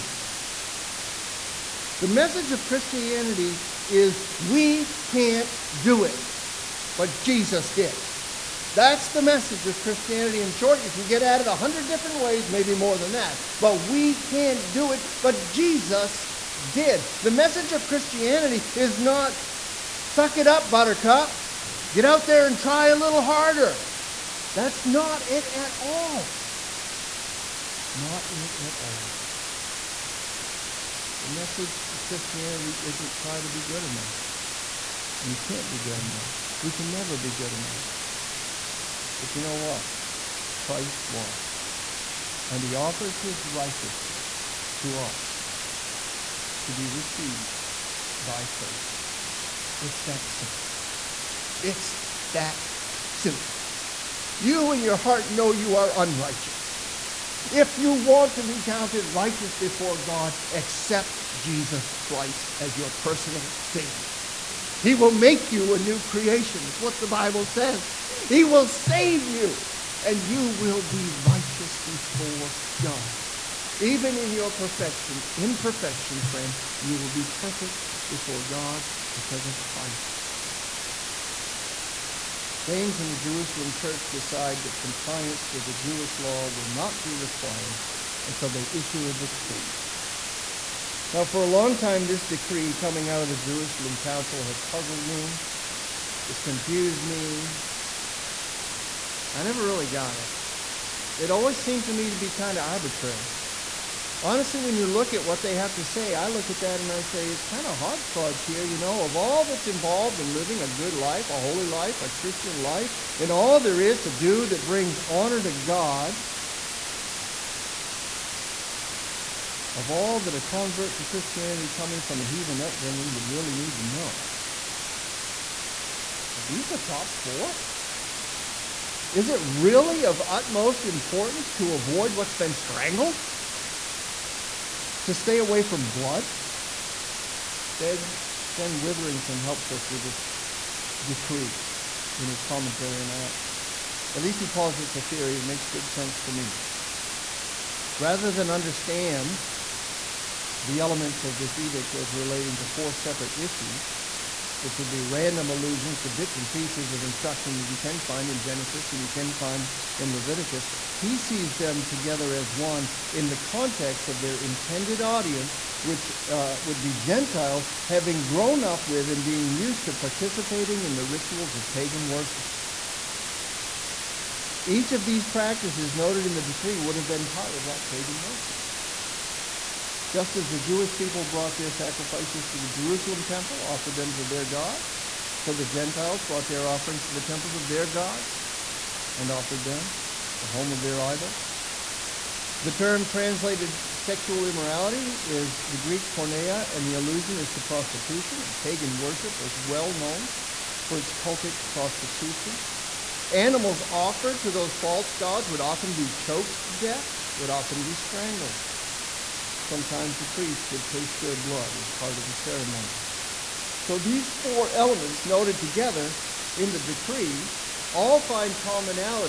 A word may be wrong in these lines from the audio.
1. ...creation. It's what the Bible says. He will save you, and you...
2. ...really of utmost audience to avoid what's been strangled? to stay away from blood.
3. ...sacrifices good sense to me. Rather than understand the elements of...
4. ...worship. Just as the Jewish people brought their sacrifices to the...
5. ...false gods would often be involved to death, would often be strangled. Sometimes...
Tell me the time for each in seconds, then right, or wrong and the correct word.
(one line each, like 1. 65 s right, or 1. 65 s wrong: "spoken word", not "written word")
1. 66 s right
2. 129 s wrong: "importance", not "audience"
3. 145 s wrong: "makes", not "sacrifices"
4. 178 s right
5. 204 s wrong: "choked", not "involved".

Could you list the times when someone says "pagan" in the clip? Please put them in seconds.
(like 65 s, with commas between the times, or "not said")
171 s, 177 s, 198 s.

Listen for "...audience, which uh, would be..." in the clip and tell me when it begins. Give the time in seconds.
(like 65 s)
165 s.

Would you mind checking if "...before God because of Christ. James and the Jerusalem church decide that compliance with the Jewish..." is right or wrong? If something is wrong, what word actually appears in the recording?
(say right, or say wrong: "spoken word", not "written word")
right.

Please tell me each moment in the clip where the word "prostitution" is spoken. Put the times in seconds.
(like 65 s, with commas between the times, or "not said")
197 s, 201 s.